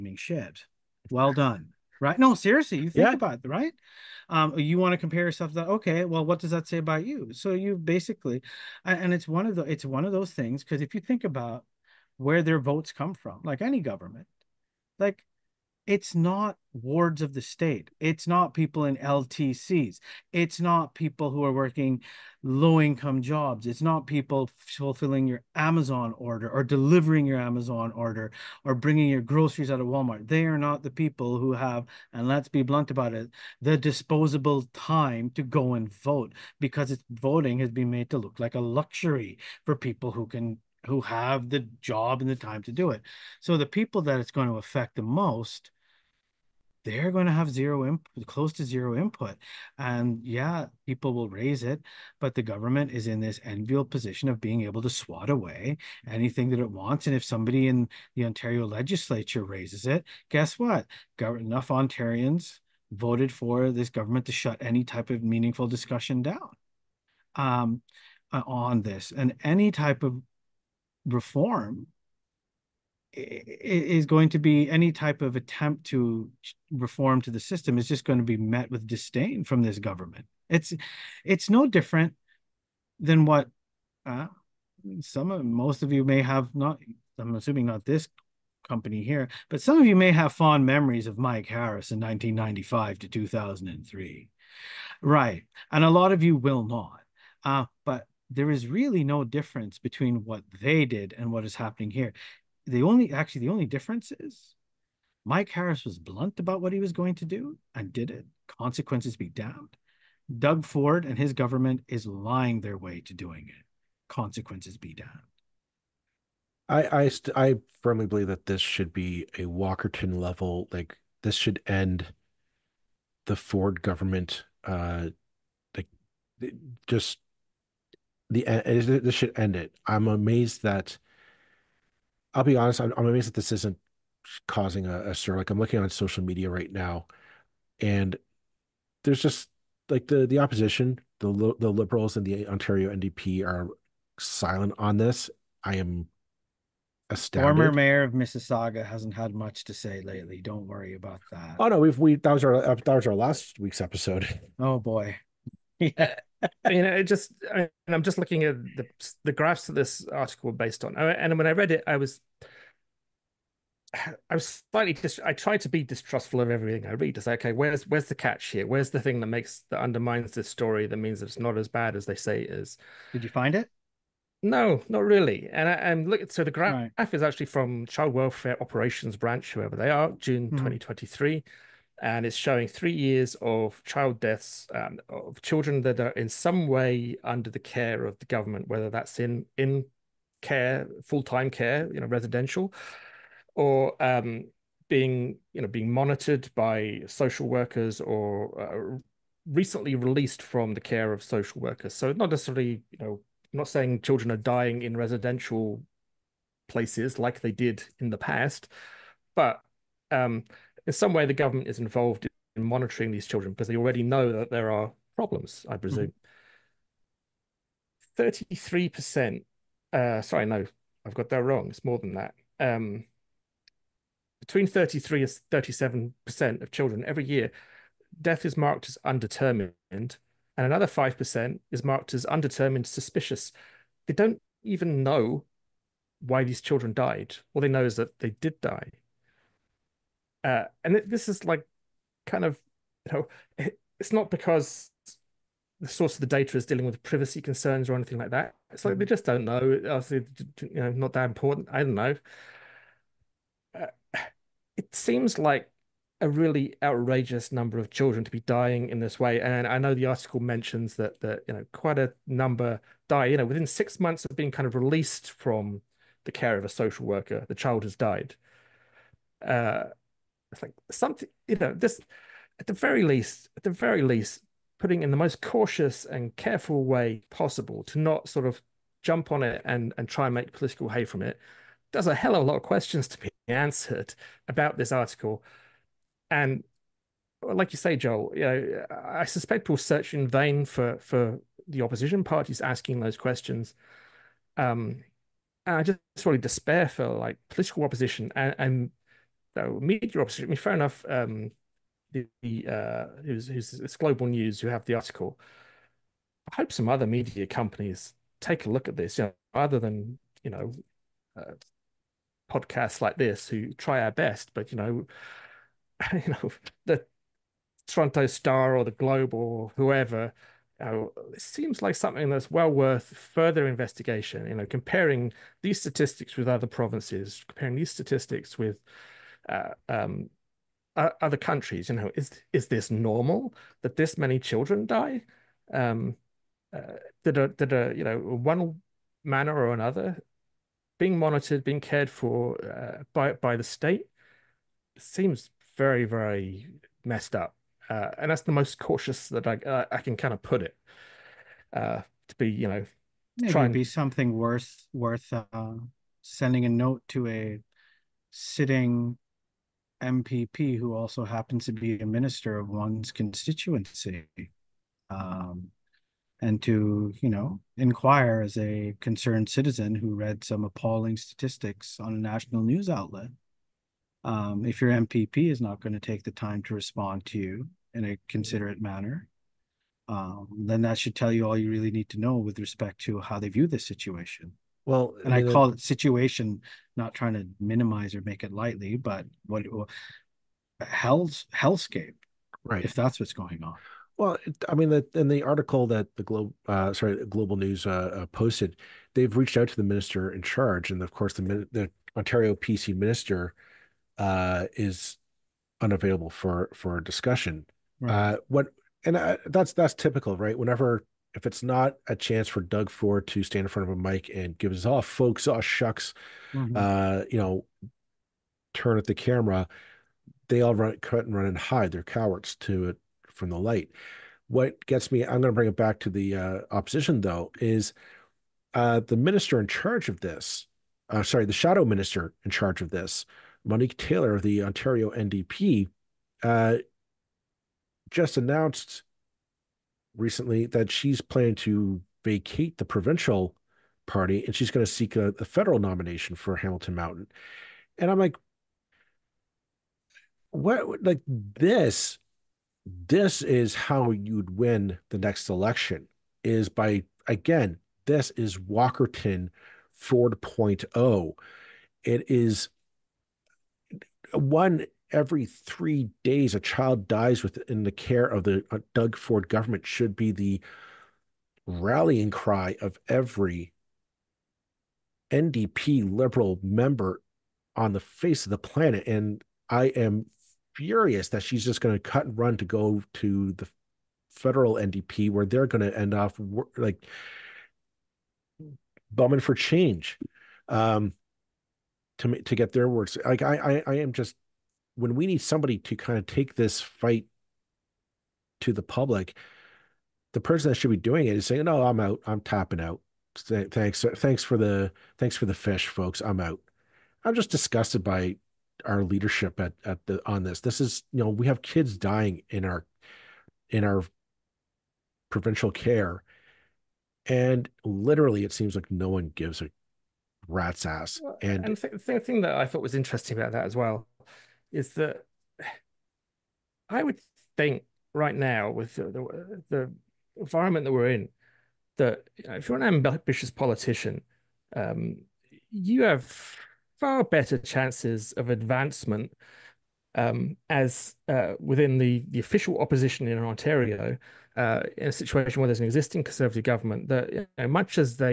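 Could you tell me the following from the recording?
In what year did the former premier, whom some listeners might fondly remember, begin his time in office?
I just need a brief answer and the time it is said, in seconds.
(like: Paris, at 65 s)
1995, at 91 s.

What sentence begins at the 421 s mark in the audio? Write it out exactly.
They're cowards to it from the light.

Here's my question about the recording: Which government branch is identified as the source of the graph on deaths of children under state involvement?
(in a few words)
Child Welfare Operations Branch.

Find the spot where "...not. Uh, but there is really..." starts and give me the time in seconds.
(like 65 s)
96 s.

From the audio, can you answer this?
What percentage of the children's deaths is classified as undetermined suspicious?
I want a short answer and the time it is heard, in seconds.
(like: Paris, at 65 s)
5%, at 230 s.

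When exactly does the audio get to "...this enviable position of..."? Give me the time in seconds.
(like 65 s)
53 s.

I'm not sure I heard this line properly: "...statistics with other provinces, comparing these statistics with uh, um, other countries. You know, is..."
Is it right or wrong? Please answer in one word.
right.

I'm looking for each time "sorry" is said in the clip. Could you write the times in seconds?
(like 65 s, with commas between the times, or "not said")
220 s, 396 s, 431 s.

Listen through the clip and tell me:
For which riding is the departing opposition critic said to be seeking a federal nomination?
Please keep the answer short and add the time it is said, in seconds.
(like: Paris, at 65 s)
Hamilton Mountain, at 446 s.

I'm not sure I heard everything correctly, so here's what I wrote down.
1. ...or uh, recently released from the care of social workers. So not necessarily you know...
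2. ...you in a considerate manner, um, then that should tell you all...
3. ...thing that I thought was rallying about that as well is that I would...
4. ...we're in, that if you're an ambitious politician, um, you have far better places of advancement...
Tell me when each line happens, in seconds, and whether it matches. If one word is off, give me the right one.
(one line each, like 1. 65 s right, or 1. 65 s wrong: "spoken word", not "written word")
1. 198 s right
2. 377 s right
3. 522 s wrong: "interesting", not "rallying"
4. 530 s wrong: "chances", not "places".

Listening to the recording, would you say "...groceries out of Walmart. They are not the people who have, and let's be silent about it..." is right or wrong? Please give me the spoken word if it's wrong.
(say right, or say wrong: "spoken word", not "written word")
wrong: "blunt", not "silent".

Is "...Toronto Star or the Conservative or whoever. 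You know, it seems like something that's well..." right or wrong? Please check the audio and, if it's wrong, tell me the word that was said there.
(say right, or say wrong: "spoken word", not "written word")
wrong: "Globe", not "Conservative".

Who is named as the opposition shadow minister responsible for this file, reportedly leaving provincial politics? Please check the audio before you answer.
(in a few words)
Monique Taylor.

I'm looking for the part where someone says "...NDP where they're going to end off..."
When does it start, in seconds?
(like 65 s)
484 s.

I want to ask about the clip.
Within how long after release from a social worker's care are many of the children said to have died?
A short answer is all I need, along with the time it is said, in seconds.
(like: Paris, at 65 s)
6 months, at 263 s.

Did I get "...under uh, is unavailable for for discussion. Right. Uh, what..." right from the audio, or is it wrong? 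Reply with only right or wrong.
wrong.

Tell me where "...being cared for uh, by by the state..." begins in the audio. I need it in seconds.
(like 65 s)
341 s.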